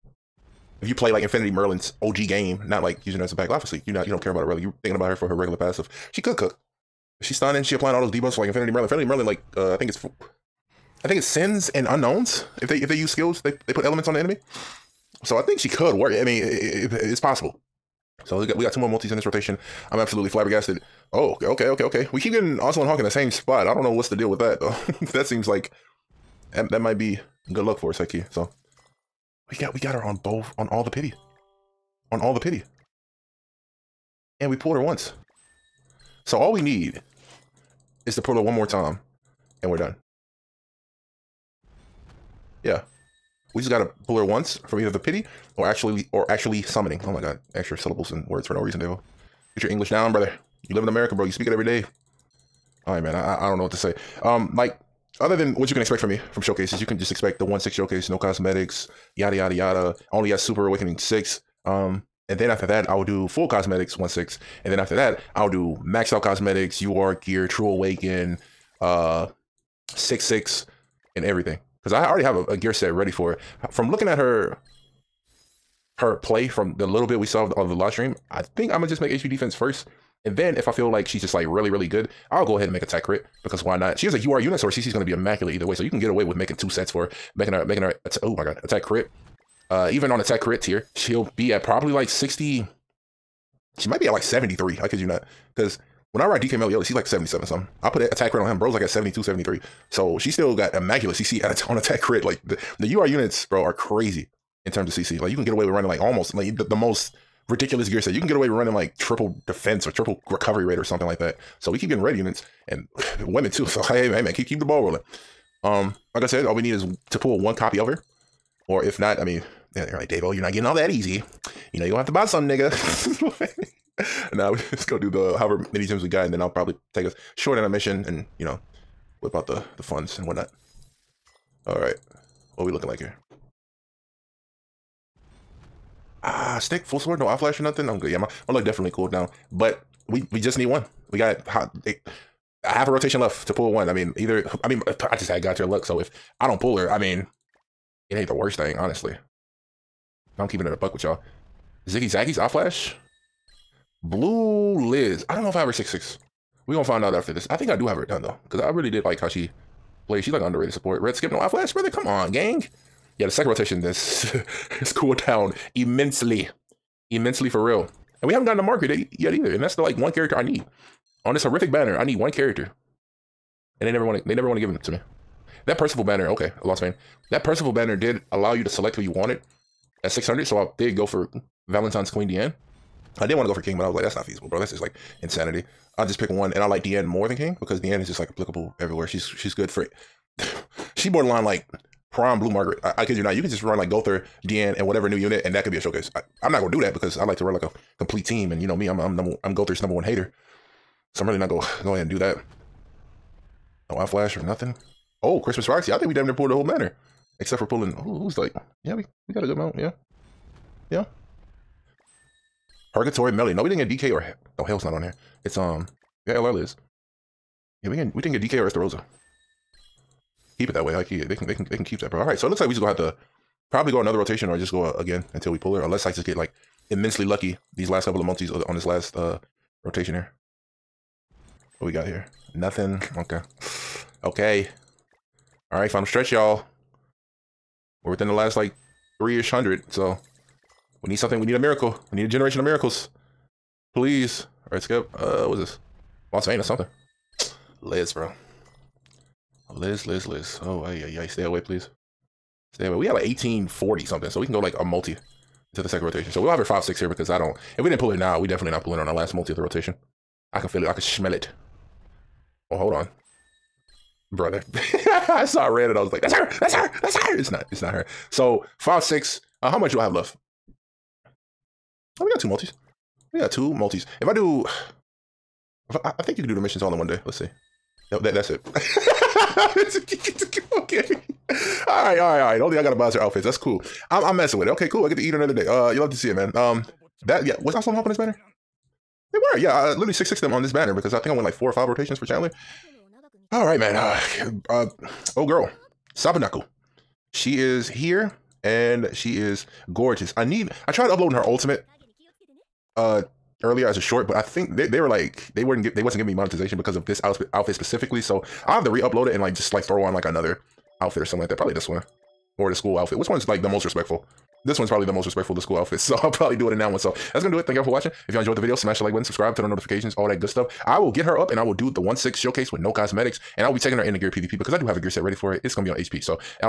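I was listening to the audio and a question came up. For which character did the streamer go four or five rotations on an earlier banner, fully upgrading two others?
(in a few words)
Chandler.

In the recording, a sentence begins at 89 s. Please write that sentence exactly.
Uh, even on attack crit tier, she'll be at probably like sixty.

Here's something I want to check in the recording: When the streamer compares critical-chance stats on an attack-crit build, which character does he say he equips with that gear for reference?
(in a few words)
DK Meliodas.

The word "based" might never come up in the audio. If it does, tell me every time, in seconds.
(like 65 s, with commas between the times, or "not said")
not said.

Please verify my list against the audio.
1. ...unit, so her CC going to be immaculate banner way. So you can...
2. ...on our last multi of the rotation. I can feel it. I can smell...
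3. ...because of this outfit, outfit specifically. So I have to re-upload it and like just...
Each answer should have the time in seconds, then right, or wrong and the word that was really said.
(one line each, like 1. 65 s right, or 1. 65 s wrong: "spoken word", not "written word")
1. 84 s wrong: "either", not "banner"
2. 258 s right
3. 306 s right.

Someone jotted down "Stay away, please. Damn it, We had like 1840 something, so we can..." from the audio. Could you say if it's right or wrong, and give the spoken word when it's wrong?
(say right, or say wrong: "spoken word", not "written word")
right.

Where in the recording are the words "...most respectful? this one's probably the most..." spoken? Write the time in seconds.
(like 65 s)
313 s.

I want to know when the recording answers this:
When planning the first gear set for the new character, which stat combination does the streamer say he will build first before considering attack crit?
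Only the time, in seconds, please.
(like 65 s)
79 s.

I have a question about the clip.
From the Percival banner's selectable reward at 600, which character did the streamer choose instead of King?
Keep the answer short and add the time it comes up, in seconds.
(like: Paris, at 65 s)
Valentine's Queen Diane, at 181 s.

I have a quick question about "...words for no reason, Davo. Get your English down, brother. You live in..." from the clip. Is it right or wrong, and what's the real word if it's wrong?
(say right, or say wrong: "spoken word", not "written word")
right.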